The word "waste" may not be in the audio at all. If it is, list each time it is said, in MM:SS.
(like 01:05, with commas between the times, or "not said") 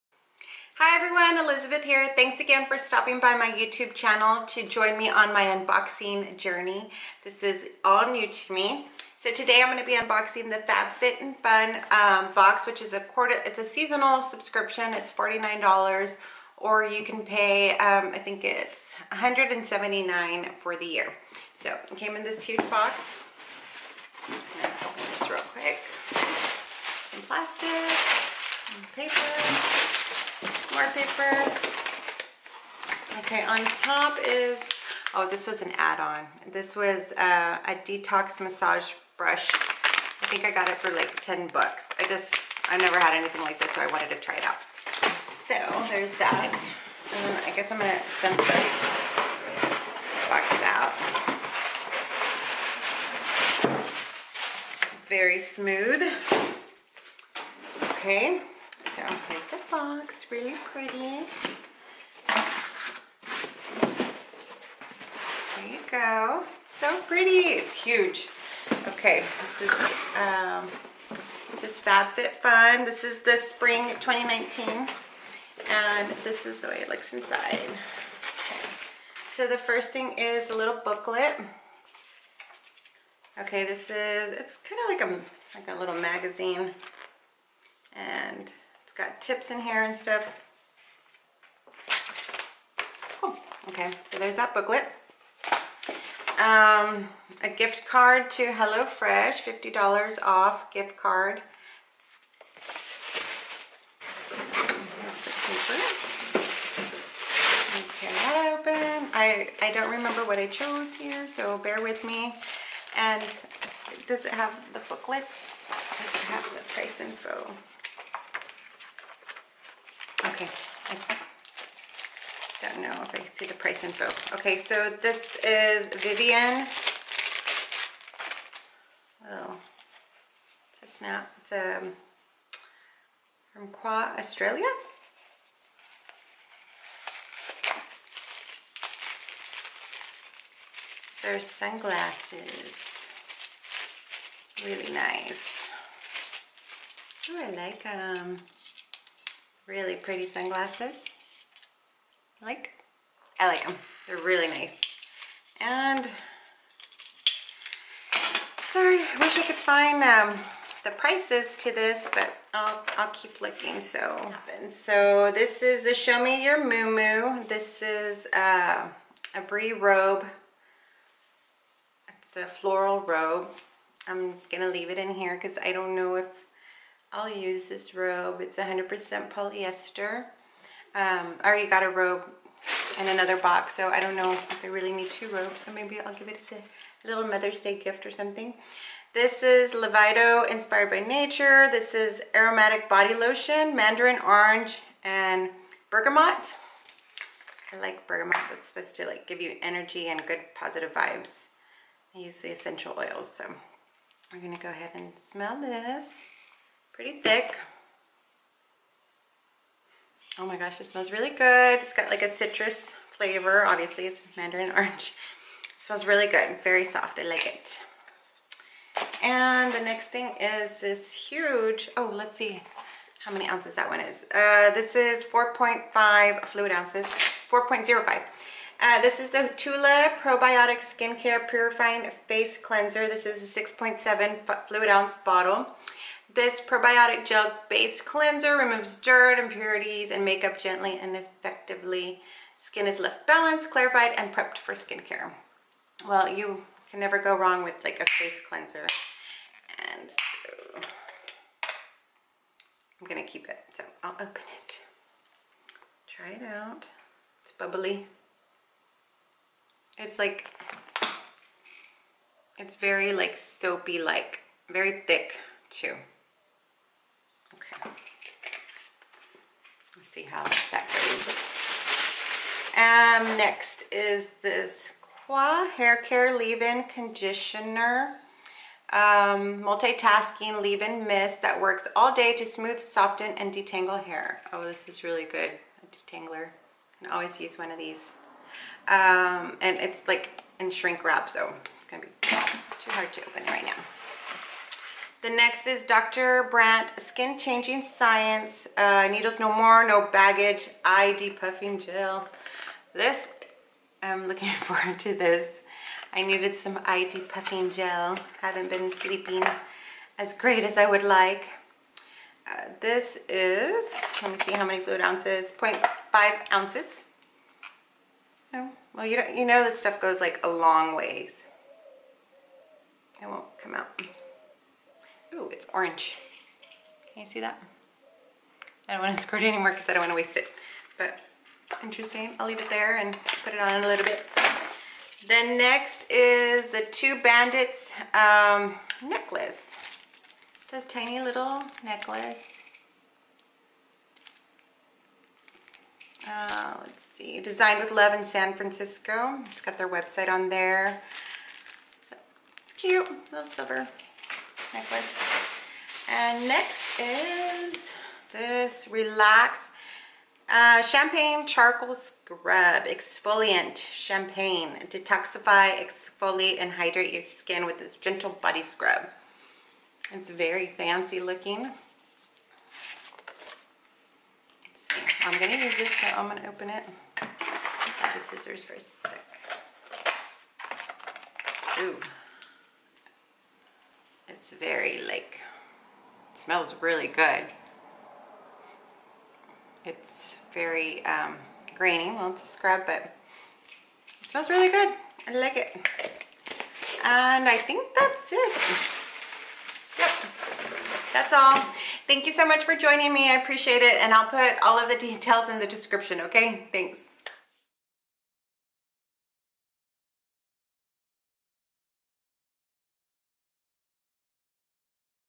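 05:30.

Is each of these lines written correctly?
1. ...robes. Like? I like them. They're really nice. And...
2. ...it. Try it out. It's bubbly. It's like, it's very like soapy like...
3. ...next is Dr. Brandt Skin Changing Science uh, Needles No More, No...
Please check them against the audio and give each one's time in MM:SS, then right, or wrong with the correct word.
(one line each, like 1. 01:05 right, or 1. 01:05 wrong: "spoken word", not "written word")
1. 02:30 wrong: "sunglasses", not "robes"
2. 04:14 right
3. 04:55 right.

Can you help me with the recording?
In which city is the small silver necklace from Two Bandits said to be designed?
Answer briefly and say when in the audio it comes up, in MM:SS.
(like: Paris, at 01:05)
San Francisco, at 05:48.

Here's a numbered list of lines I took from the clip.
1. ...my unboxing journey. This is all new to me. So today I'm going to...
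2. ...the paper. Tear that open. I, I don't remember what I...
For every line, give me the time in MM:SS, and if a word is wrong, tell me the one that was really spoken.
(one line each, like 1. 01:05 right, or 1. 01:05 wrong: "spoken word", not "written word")
1. 00:05 right
2. 01:45 right.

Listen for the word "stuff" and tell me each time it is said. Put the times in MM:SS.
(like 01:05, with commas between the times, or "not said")
01:29, 05:19.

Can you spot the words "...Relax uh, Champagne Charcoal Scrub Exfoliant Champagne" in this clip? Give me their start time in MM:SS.
05:58.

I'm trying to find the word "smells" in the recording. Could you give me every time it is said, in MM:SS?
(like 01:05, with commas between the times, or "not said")
03:25, 03:30, 03:35, 06:26, 06:34.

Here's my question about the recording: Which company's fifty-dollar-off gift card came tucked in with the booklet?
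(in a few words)
HelloFresh.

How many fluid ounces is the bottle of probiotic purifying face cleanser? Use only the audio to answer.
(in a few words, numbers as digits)
6.7.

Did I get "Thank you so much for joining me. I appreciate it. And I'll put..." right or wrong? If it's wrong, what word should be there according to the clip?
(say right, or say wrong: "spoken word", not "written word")
right.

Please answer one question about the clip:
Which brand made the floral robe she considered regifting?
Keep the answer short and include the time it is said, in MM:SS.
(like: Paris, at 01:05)
Show Me Your Mumu, at 02:45.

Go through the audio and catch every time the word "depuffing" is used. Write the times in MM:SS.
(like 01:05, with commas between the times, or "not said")
05:01, 05:07.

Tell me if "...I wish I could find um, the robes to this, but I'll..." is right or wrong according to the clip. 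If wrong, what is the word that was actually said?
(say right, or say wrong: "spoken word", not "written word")
wrong: "prices", not "robes".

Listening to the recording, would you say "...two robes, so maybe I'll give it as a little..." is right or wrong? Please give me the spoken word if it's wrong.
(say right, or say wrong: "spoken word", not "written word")
right.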